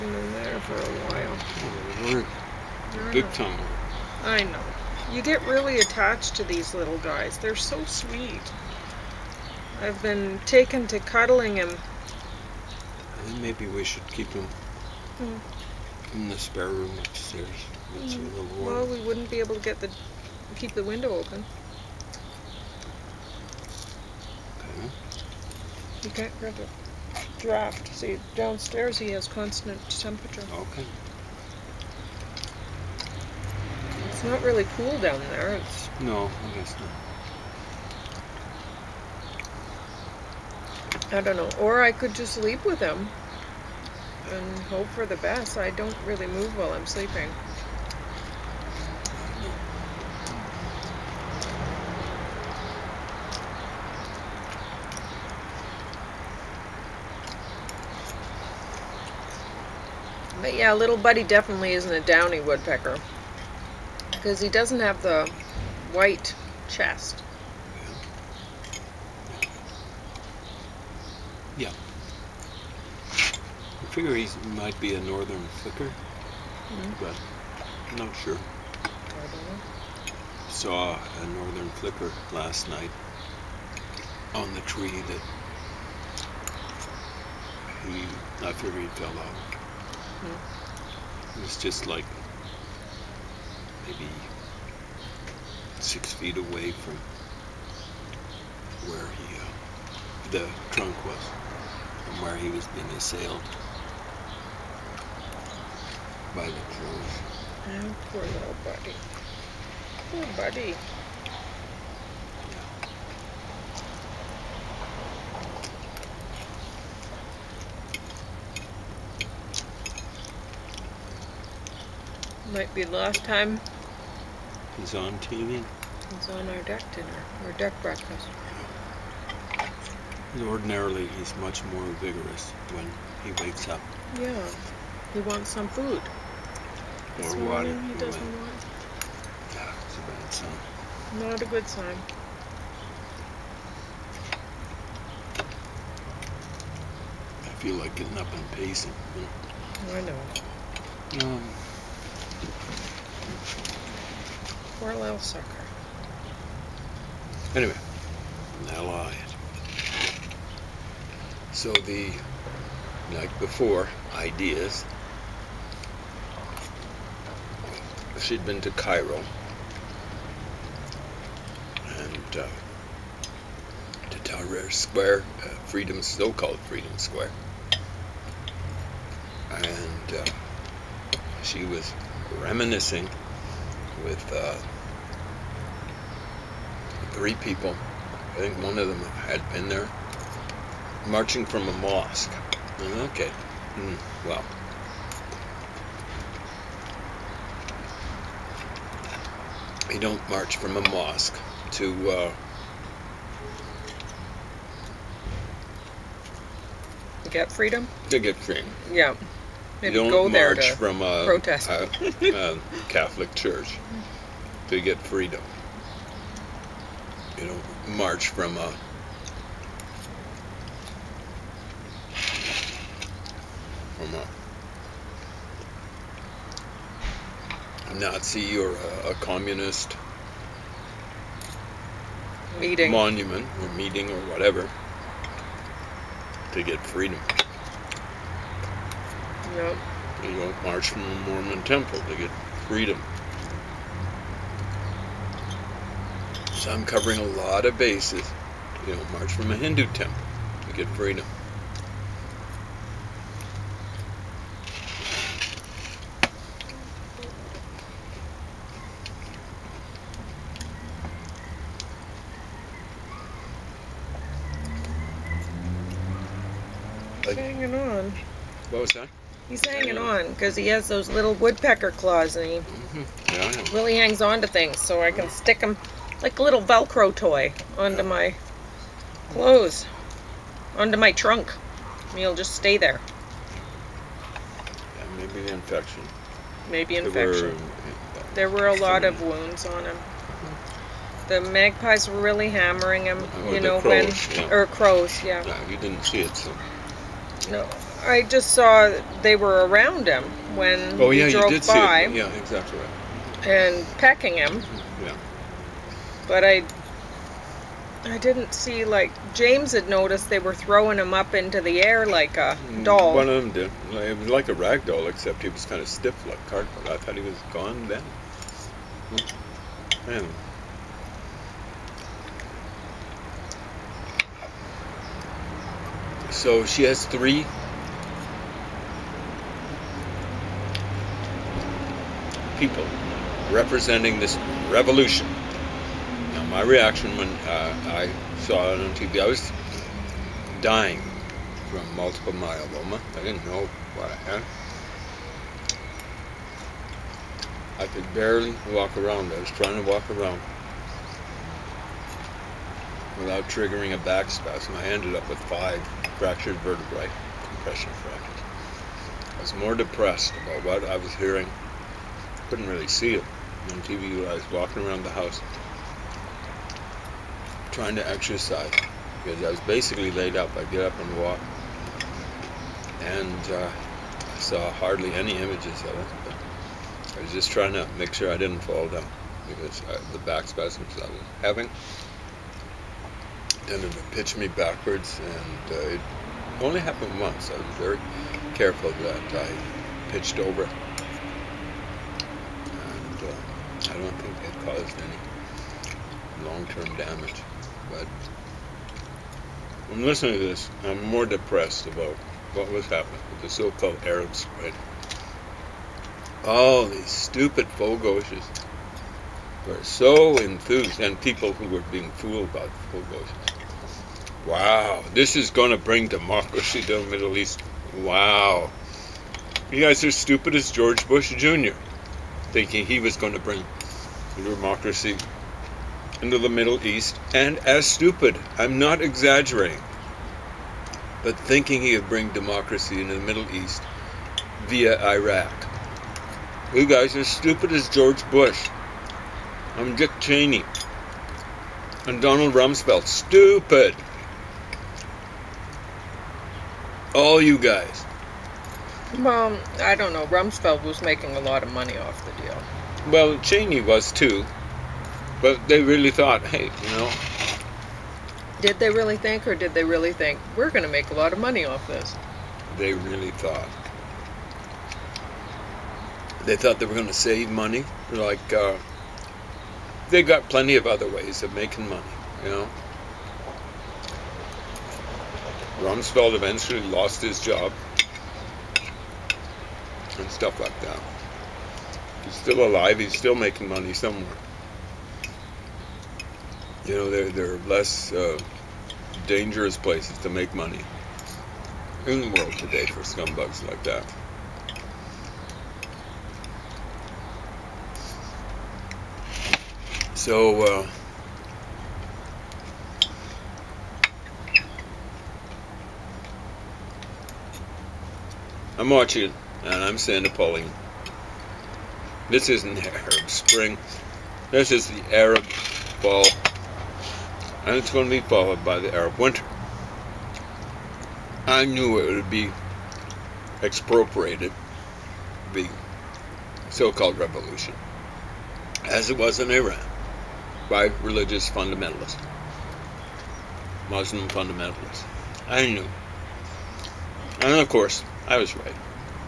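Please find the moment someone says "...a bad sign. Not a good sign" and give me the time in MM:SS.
02:19.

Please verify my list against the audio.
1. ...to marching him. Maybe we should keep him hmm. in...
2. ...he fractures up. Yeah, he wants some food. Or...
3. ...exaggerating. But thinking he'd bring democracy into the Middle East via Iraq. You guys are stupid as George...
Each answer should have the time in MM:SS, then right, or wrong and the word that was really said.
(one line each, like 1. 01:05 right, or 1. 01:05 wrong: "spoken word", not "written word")
1. 00:10 wrong: "cuddling", not "marching"
2. 02:13 wrong: "wakes", not "fractures"
3. 07:09 right.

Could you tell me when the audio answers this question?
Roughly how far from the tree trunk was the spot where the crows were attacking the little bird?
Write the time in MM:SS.
01:35.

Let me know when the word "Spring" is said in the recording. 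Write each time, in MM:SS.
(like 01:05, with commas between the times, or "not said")
06:44, 08:33.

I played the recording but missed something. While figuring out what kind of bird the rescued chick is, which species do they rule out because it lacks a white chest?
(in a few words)
downy woodpecker.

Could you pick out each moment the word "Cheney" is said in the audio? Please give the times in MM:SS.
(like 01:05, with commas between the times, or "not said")
07:20, 07:33.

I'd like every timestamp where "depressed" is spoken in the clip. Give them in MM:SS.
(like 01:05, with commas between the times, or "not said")
05:59, 06:41.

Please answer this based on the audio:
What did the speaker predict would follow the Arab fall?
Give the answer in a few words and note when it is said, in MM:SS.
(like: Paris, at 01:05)
Arab winter, at 08:38.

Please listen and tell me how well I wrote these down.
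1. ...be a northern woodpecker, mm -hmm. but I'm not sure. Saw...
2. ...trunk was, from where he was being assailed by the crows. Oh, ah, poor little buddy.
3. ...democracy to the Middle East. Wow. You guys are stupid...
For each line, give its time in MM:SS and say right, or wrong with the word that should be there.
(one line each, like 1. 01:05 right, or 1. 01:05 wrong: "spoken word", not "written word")
1. 01:14 wrong: "flicker", not "woodpecker"
2. 01:40 right
3. 06:56 right.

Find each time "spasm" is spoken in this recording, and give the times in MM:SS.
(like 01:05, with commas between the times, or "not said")
05:54, 06:20.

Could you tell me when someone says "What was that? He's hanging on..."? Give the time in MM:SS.
04:28.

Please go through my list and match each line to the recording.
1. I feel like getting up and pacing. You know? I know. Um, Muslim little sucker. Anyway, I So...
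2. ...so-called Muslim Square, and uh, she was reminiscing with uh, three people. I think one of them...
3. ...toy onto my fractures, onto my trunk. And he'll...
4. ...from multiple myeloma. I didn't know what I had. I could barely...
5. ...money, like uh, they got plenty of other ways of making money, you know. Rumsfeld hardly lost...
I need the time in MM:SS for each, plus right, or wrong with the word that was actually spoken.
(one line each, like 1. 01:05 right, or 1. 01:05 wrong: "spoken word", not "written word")
1. 02:27 wrong: "Poor", not "Muslim"
2. 02:56 wrong: "Freedom", not "Muslim"
3. 04:37 wrong: "clothes", not "fractures"
4. 05:41 right
5. 07:47 wrong: "eventually", not "hardly".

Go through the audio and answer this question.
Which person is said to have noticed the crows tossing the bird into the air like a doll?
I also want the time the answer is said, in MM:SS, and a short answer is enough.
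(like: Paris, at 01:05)
James, at 05:09.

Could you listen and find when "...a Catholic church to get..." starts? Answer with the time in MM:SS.
03:32.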